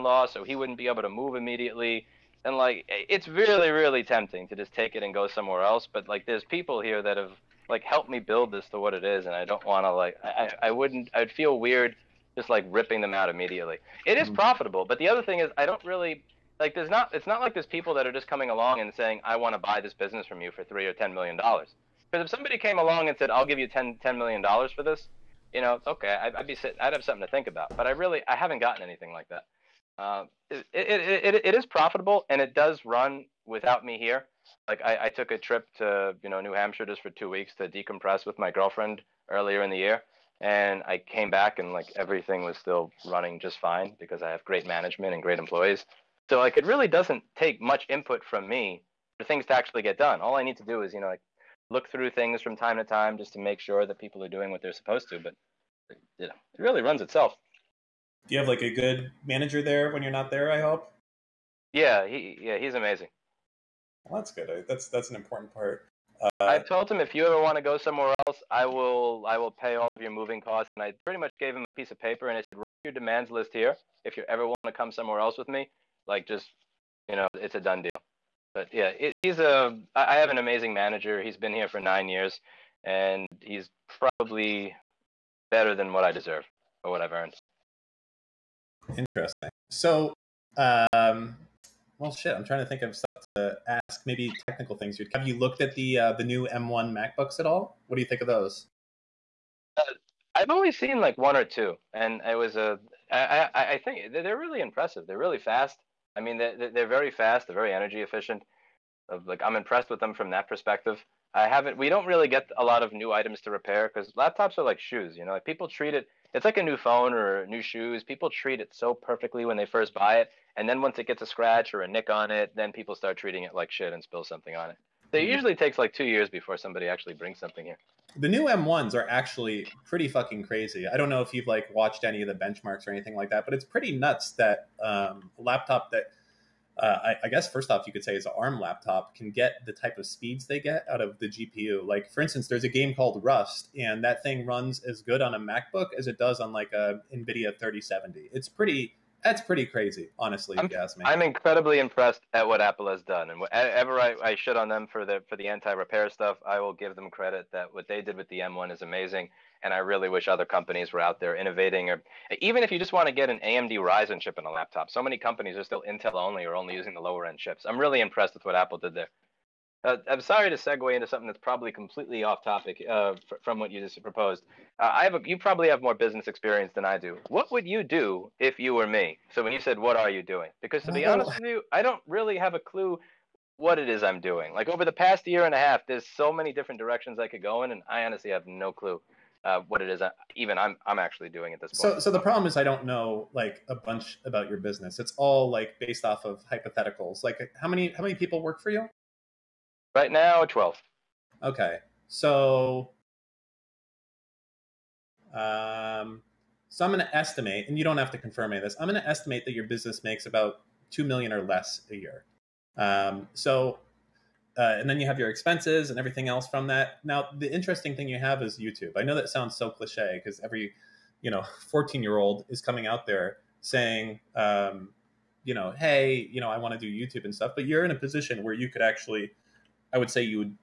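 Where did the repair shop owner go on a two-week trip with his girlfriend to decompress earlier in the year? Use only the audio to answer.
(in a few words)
New Hampshire.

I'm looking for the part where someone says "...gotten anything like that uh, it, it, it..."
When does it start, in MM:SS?
00:28.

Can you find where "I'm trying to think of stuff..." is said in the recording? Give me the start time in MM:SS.
01:32.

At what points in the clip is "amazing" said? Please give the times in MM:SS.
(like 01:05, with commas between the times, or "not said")
01:02, 01:20, 02:38.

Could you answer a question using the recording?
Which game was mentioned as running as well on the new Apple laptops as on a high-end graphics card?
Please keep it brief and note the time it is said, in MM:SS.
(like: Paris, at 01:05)
Rust, at 02:23.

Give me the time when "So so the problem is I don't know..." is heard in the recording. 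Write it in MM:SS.
03:11.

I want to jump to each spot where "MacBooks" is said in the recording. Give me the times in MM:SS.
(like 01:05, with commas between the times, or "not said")
01:36, 02:25.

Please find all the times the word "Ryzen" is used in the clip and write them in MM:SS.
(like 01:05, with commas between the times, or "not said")
02:43.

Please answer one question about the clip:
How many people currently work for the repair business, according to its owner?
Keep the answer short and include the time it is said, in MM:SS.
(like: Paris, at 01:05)
12, at 03:20.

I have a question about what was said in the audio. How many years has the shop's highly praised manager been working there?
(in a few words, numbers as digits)
9.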